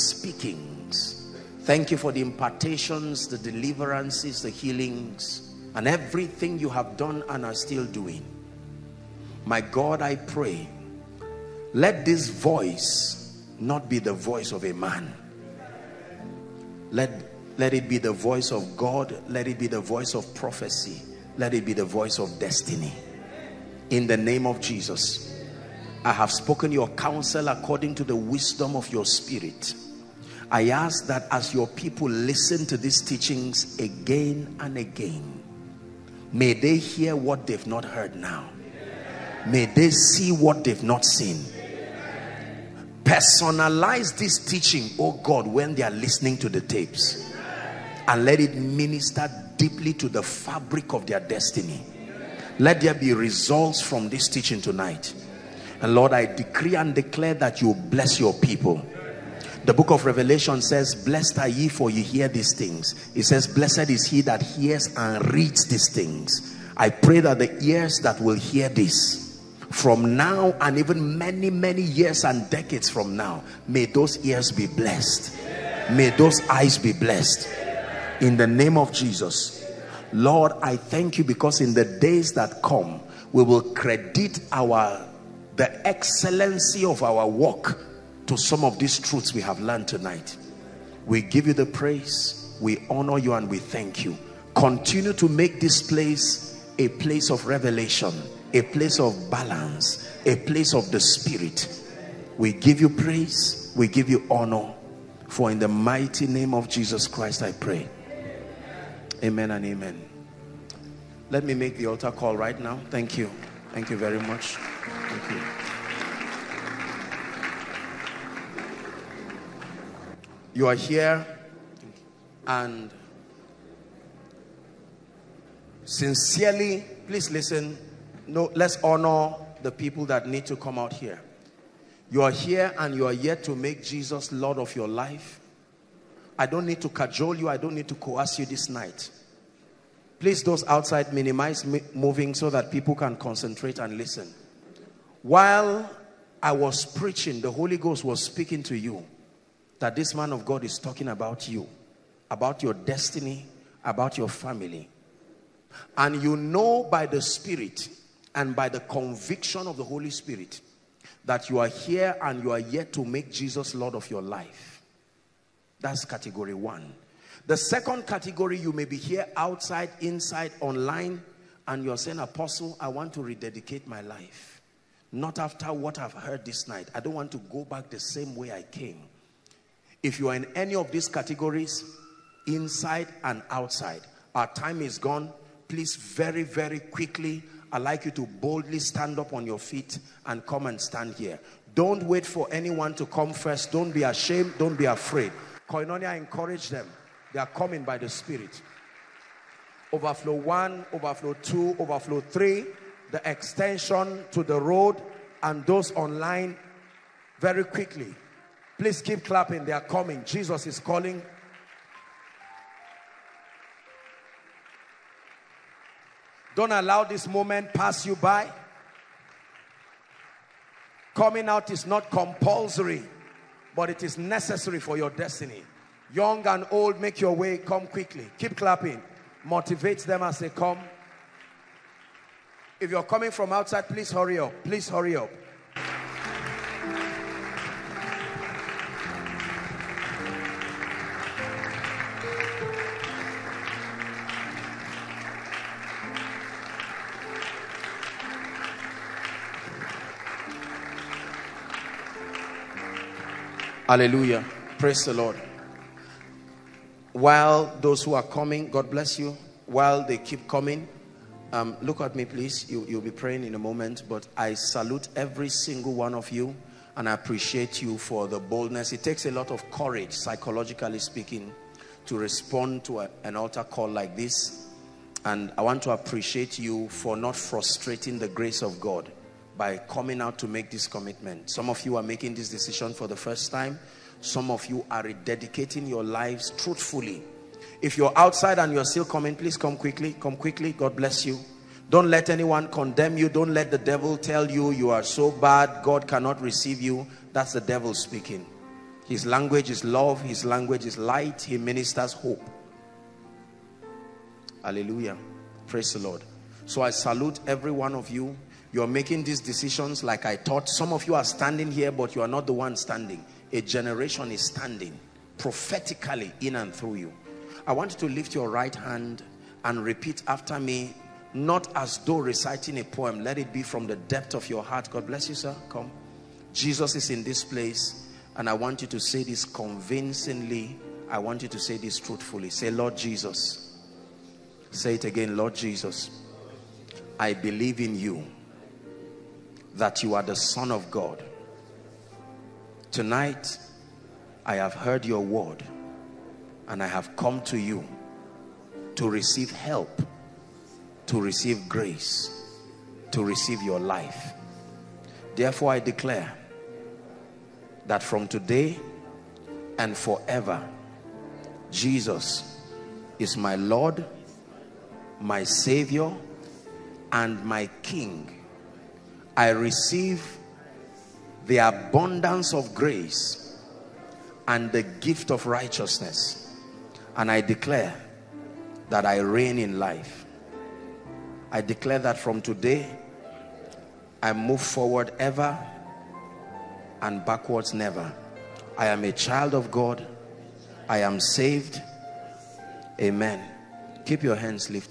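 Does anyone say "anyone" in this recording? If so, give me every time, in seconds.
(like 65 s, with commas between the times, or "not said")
192 s, 292 s.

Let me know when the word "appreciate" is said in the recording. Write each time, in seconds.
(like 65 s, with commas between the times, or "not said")
267 s, 275 s.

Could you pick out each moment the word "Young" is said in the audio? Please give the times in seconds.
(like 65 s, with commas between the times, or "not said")
226 s.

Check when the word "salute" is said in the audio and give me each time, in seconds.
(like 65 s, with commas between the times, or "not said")
264 s, 306 s.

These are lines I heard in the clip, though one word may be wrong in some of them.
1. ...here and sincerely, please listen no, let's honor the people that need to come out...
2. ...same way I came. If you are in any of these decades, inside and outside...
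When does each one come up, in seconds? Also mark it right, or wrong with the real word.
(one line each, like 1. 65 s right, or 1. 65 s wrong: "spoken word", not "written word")
1. 120 s right
2. 177 s wrong: "categories", not "decades".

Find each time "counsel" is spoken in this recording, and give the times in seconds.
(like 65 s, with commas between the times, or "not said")
26 s.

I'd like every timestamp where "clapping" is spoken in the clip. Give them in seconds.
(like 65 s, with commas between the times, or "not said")
209 s, 228 s.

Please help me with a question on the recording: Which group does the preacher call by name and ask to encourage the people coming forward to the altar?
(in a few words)
Koinonia.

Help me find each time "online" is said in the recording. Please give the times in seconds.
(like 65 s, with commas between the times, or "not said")
170 s, 205 s.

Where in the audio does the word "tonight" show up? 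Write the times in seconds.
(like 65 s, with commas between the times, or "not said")
54 s, 89 s, 342 s.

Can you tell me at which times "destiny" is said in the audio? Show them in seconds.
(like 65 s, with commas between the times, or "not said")
22 s, 51 s, 152 s, 225 s.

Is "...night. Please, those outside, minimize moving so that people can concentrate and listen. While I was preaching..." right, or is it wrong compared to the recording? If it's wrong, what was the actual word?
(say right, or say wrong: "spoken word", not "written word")
right.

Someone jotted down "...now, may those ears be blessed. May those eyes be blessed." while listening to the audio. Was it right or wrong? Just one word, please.
right.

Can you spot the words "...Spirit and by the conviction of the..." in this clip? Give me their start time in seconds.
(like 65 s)
157 s.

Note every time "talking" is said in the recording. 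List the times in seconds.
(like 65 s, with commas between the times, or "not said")
150 s.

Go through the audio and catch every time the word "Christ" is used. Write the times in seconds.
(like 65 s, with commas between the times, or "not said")
107 s.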